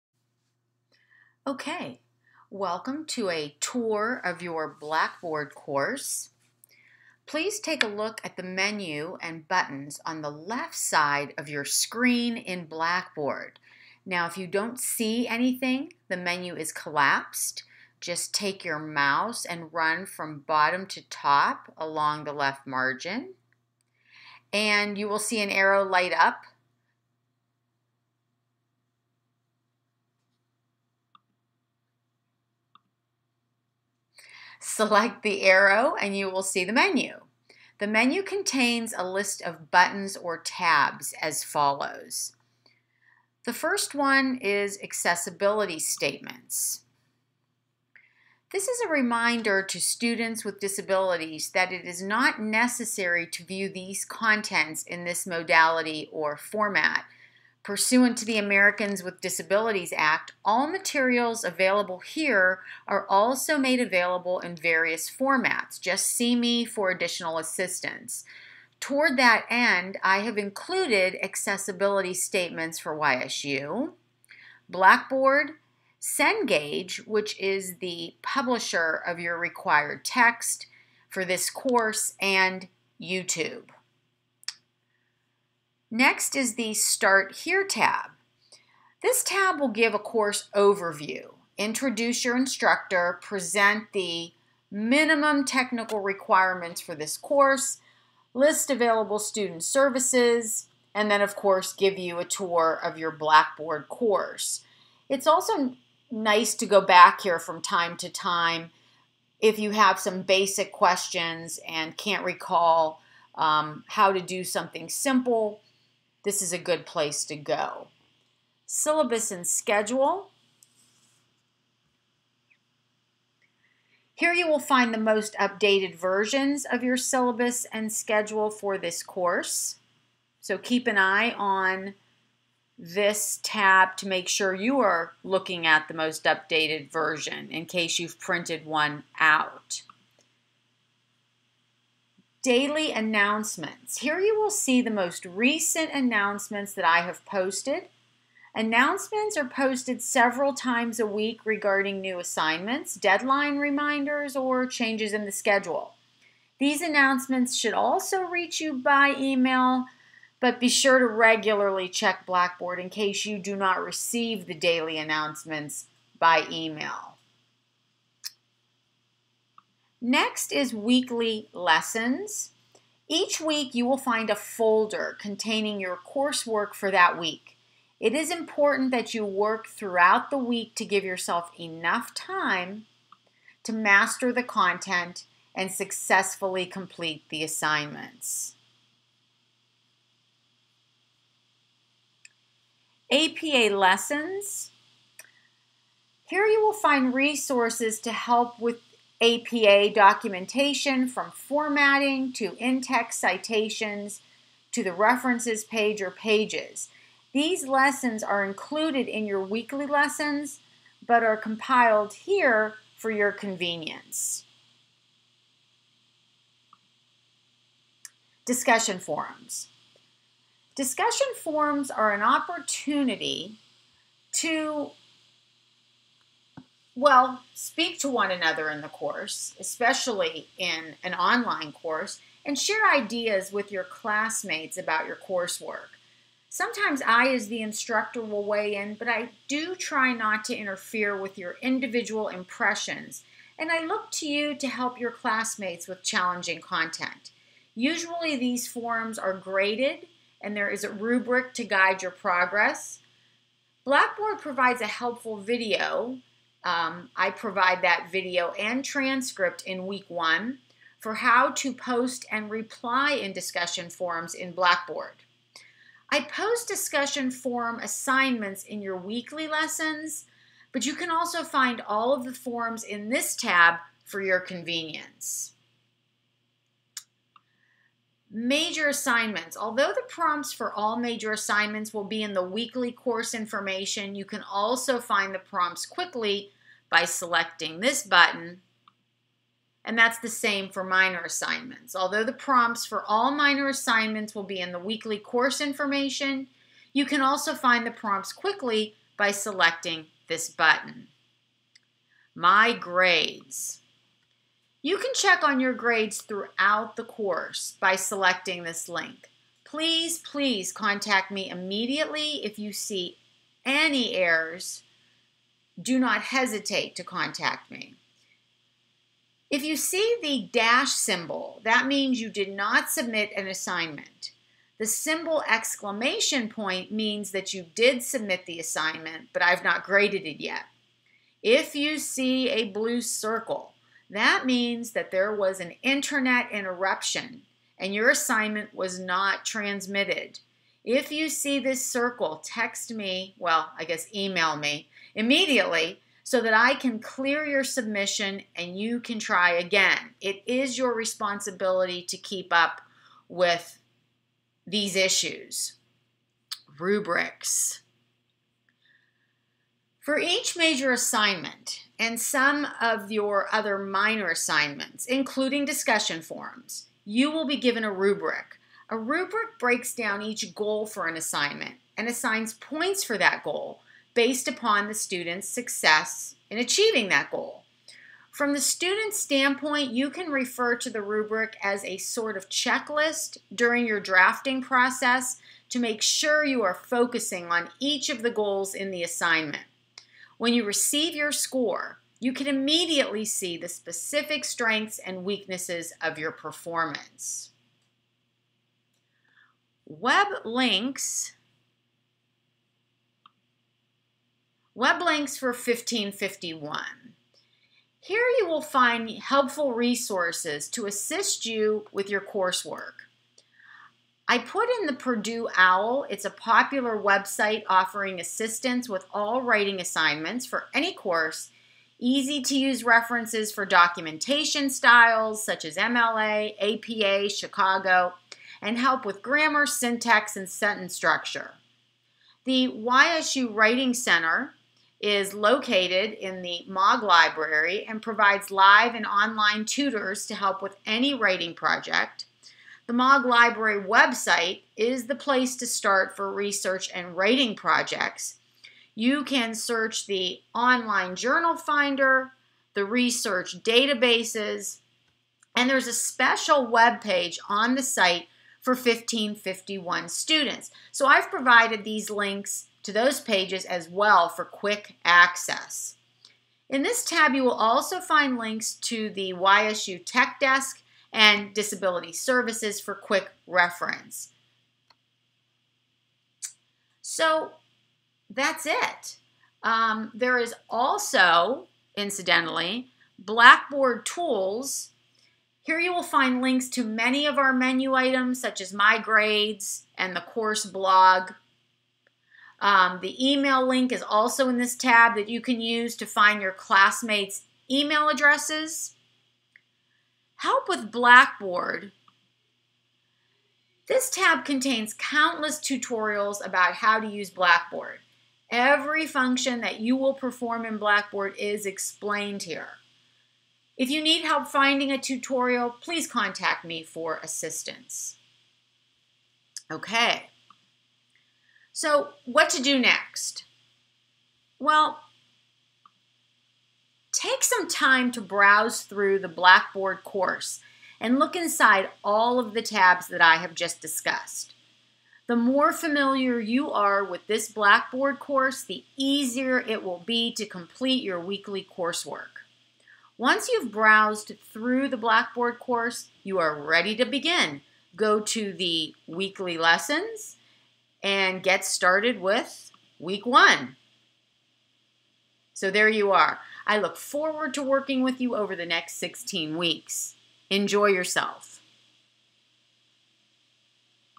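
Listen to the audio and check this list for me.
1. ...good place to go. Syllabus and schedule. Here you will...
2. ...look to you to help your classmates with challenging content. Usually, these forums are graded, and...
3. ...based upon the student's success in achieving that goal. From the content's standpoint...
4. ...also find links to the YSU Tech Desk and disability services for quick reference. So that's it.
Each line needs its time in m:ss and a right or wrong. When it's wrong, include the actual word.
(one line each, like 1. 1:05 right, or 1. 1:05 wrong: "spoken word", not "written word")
1. 1:56 right
2. 4:03 right
3. 6:14 wrong: "student", not "content"
4. 7:47 right.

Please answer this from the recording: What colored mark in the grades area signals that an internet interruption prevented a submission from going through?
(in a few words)
blue circle.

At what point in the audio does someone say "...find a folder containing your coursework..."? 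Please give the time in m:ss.
2:53.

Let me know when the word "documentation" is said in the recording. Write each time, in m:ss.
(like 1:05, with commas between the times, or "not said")
3:19, 7:03.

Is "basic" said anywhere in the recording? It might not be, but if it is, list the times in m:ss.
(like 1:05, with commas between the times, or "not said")
1:50.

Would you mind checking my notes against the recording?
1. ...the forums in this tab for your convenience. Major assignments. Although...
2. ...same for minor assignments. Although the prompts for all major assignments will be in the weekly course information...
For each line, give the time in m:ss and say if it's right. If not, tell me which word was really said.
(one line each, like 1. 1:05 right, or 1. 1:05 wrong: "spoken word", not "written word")
1. 4:32 right
2. 4:50 wrong: "minor", not "major".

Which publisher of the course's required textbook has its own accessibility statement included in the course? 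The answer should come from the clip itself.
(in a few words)
Cengage.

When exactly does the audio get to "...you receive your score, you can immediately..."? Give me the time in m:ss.
6:30.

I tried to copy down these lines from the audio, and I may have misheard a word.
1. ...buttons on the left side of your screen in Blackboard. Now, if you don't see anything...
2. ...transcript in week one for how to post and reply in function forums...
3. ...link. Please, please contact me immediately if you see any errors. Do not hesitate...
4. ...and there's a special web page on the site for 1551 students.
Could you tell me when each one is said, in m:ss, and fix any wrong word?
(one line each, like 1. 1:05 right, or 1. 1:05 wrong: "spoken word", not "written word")
1. 0:09 right
2. 4:18 wrong: "discussion", not "function"
3. 5:08 right
4. 7:35 right.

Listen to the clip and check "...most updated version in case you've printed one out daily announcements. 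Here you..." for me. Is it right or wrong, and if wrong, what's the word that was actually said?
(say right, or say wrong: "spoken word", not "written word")
right.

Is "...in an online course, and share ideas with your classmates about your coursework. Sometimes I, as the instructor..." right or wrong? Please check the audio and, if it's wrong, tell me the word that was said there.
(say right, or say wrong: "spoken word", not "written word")
right.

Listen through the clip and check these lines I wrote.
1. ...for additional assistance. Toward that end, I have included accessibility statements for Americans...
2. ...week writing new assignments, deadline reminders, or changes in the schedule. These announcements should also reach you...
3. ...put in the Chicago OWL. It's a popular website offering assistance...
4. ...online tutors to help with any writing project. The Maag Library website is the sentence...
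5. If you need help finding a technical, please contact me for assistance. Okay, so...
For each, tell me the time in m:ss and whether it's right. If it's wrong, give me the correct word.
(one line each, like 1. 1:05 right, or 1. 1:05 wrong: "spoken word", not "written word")
1. 1:06 wrong: "YSU", not "Americans"
2. 2:31 wrong: "regarding", not "writing"
3. 6:54 wrong: "Purdue", not "Chicago"
4. 7:19 wrong: "place", not "sentence"
5. 8:33 wrong: "tutorial", not "technical".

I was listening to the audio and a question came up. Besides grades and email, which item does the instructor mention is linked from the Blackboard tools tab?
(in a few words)
course blog.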